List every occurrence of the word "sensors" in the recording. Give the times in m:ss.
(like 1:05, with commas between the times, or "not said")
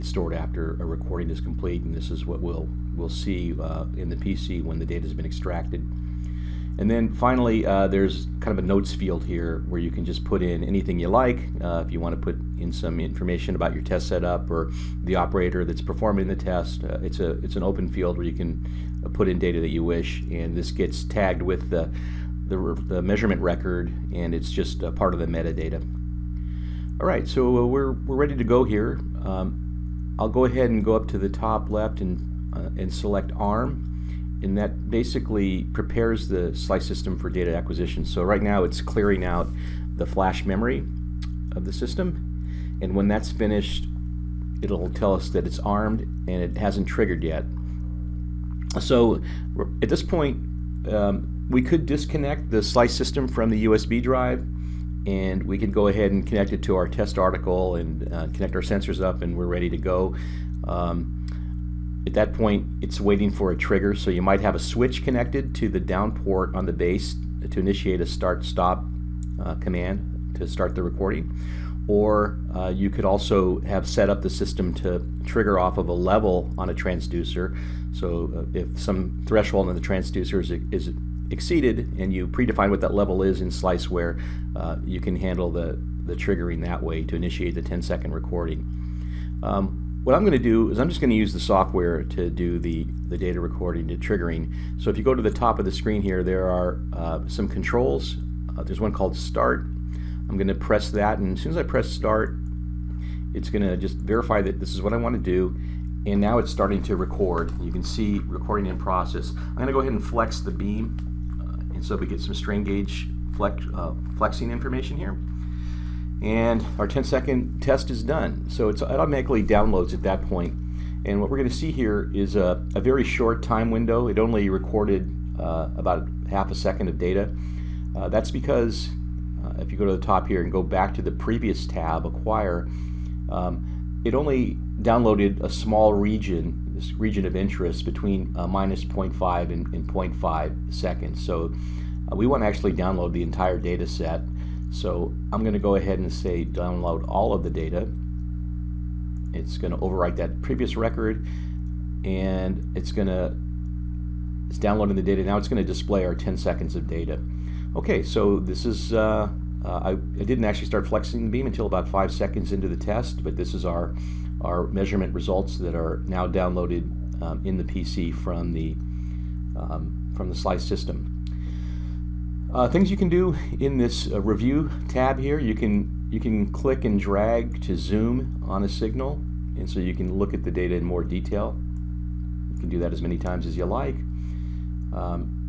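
0:58.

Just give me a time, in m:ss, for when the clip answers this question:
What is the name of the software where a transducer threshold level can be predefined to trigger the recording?
1:23.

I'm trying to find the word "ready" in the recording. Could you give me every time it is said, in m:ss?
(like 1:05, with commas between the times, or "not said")
0:28, 0:59.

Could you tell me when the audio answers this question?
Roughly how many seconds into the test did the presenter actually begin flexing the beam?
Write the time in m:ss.
2:41.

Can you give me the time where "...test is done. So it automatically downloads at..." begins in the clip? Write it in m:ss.
1:57.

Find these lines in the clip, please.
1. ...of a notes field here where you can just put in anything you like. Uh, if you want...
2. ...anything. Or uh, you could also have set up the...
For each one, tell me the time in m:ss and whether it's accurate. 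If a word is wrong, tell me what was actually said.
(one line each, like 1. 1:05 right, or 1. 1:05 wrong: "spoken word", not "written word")
1. 0:08 right
2. 1:10 wrong: "recording", not "anything".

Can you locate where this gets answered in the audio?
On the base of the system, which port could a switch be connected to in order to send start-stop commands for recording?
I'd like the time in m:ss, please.
1:05.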